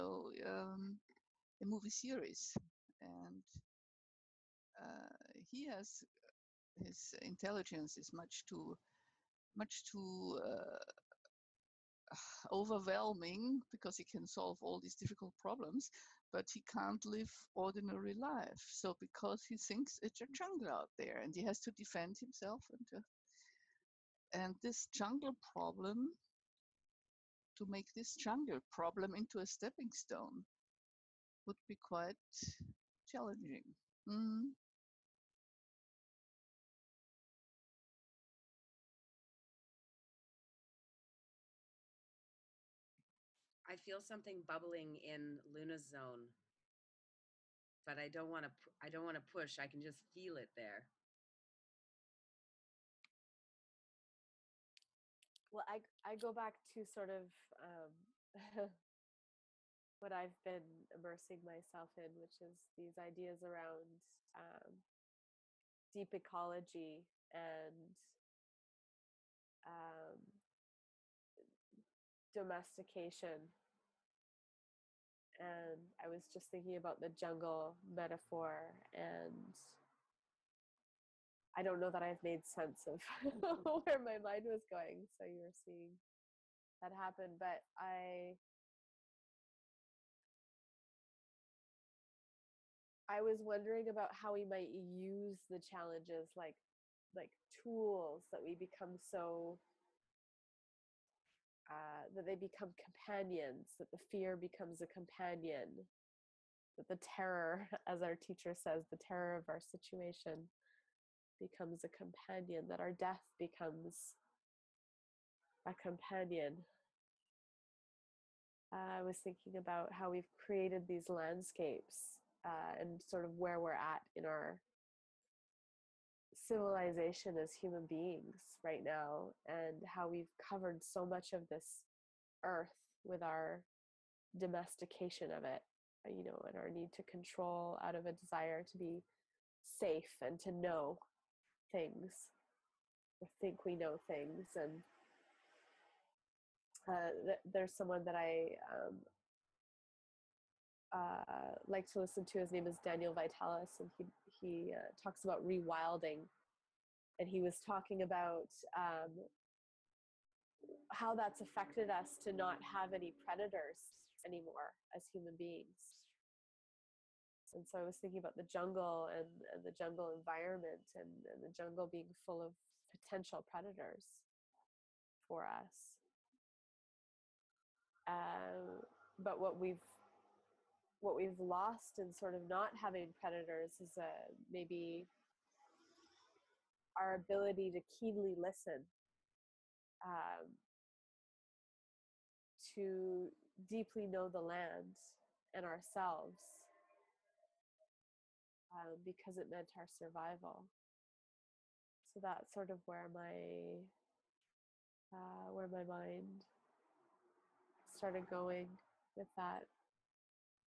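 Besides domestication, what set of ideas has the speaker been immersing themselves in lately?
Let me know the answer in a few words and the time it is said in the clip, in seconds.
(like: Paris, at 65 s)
deep ecology, at 65 s.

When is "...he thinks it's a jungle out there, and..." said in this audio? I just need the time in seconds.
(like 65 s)
19 s.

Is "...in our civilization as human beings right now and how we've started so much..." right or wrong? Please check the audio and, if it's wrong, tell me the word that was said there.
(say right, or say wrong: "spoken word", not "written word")
wrong: "covered", not "started".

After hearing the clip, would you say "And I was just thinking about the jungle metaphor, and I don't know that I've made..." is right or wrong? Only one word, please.
right.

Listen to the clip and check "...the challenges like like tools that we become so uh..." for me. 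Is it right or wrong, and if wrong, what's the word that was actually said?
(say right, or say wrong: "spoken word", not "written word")
right.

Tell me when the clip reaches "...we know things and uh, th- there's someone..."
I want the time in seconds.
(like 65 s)
143 s.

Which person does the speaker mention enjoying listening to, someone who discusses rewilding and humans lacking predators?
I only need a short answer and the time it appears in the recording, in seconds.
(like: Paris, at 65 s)
Daniel Vitalis, at 152 s.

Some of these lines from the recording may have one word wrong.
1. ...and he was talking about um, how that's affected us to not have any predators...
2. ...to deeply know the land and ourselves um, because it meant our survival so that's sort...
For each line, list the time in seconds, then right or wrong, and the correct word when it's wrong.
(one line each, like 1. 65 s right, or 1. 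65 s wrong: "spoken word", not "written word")
1. 157 s right
2. 192 s right.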